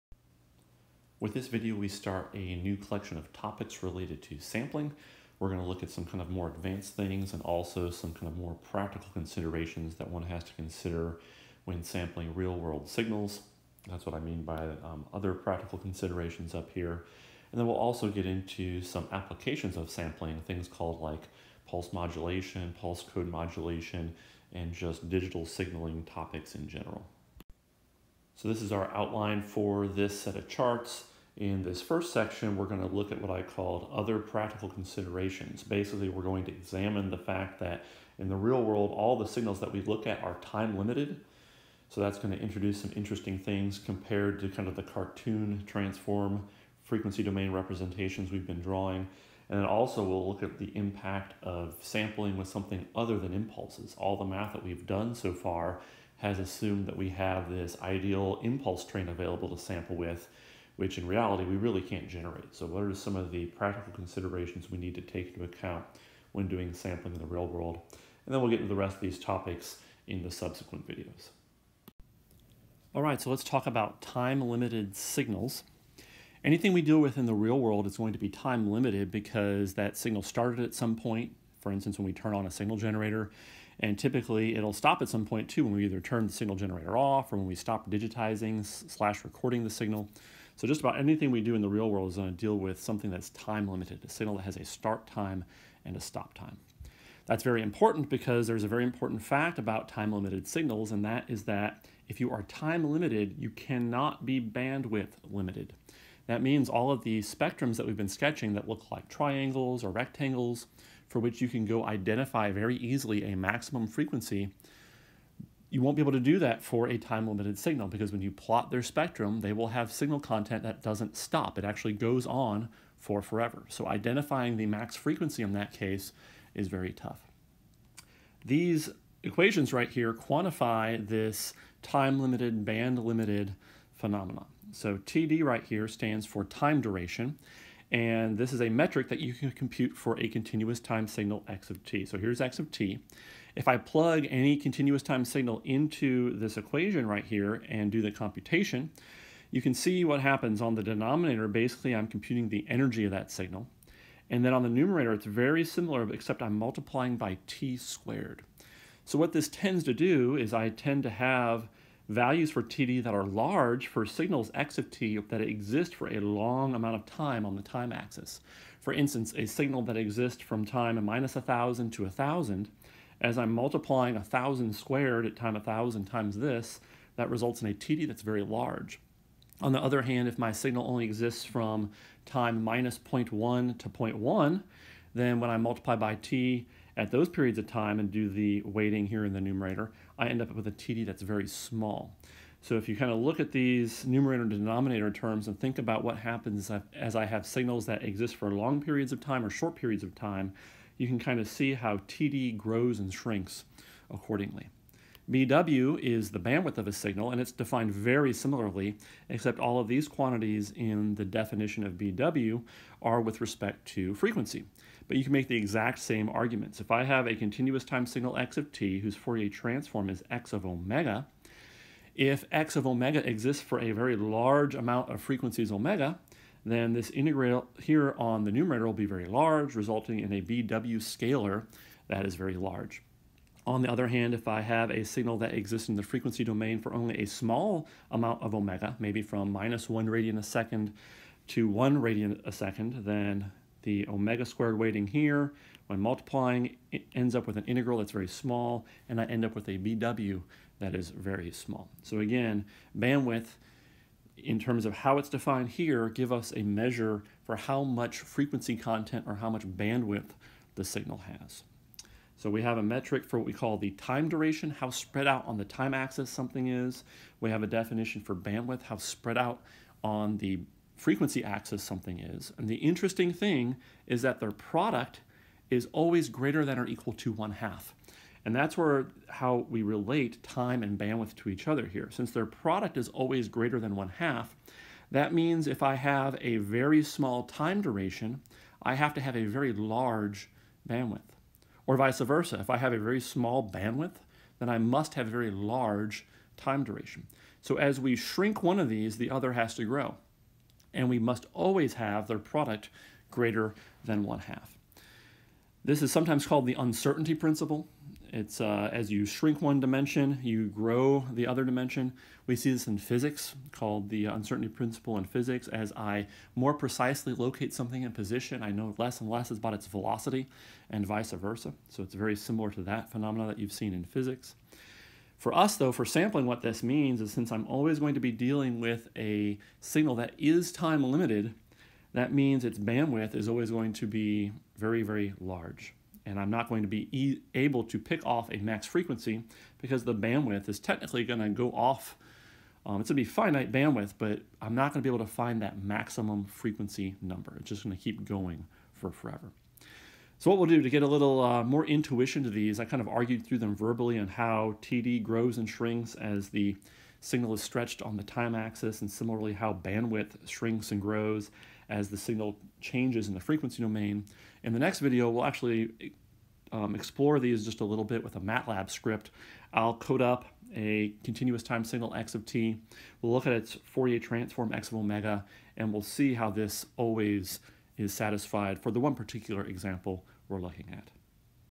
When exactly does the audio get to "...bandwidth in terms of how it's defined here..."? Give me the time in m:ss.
4:12.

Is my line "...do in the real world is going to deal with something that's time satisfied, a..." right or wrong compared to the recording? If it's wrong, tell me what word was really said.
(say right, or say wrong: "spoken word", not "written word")
wrong: "limited", not "satisfied".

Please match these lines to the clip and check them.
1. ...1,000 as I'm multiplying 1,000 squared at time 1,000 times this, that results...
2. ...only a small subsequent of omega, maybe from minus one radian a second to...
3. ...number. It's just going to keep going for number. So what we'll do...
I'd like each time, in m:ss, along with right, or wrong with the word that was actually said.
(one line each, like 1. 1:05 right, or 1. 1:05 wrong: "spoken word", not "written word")
1. 2:52 right
2. 3:56 wrong: "amount", not "subsequent"
3. 5:47 wrong: "forever", not "number".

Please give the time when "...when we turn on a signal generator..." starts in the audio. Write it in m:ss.
1:21.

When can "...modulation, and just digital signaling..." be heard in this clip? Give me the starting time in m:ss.
0:23.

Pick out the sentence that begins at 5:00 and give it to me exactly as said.
And we must always have their product greater than one half.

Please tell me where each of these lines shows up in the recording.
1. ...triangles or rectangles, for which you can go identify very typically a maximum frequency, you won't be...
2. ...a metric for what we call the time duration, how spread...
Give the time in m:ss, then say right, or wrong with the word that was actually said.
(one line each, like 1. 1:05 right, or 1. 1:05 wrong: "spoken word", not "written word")
1. 1:49 wrong: "easily", not "typically"
2. 4:22 right.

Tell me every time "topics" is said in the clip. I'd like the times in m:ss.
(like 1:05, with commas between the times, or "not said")
0:03, 0:26, 1:09.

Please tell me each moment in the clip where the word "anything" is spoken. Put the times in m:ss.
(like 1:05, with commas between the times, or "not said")
1:16, 1:30.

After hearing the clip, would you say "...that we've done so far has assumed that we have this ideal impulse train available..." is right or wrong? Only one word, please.
right.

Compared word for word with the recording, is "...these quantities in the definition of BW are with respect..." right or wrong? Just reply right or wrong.
right.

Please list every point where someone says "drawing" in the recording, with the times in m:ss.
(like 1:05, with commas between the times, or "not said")
0:48.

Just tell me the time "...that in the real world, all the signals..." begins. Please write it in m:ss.
0:37.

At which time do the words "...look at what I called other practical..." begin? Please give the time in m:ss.
0:32.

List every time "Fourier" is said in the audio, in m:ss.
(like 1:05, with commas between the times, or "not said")
3:39, 6:13.